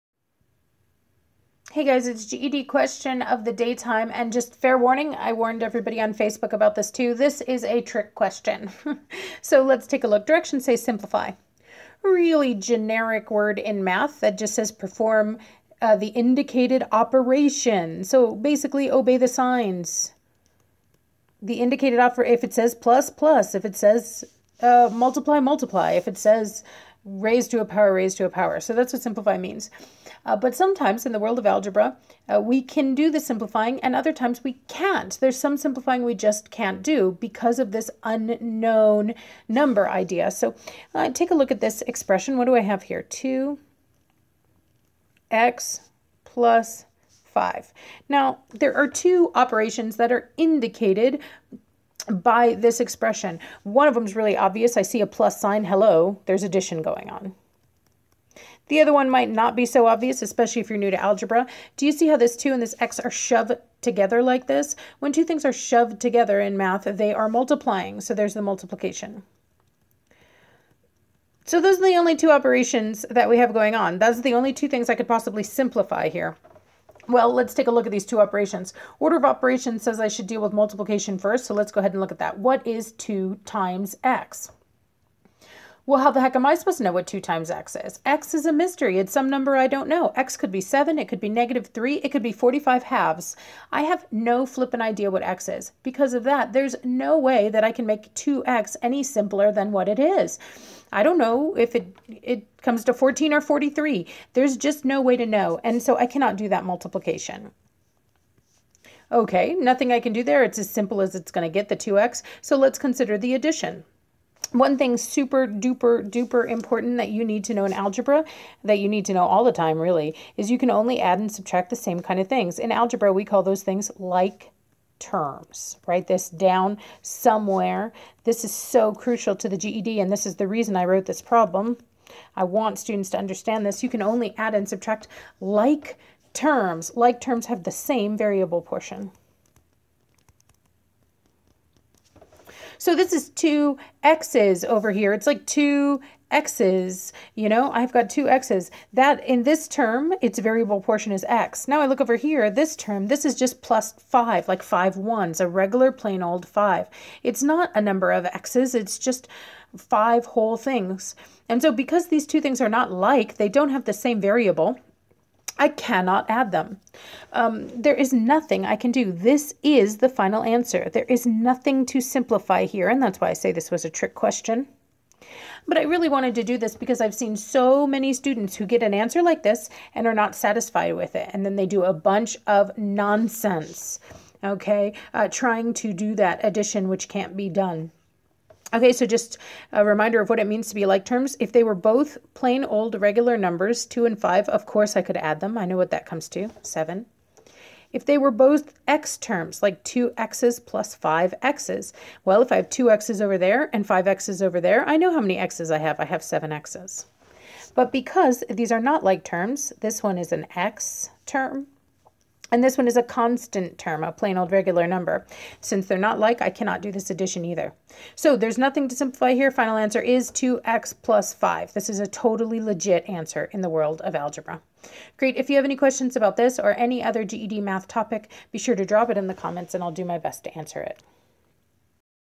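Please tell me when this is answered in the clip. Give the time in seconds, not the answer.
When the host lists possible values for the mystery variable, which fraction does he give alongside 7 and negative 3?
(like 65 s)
92 s.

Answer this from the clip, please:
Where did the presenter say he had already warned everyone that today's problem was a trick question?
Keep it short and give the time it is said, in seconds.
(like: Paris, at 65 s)
Facebook, at 6 s.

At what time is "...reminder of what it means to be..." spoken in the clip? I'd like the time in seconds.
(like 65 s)
189 s.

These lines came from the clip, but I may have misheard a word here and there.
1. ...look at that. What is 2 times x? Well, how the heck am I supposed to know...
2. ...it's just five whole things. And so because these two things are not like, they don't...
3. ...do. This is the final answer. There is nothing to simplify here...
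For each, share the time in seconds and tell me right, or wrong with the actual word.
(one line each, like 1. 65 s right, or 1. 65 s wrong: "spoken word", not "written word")
1. 81 s right
2. 158 s right
3. 168 s right.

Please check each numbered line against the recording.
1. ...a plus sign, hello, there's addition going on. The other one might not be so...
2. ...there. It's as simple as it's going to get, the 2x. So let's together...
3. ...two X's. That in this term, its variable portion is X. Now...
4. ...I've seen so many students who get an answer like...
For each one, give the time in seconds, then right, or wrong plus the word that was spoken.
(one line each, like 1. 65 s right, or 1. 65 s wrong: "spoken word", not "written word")
1. 55 s right
2. 110 s wrong: "consider", not "together"
3. 148 s right
4. 177 s right.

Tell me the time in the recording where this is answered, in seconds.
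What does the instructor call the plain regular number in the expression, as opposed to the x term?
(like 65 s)
213 s.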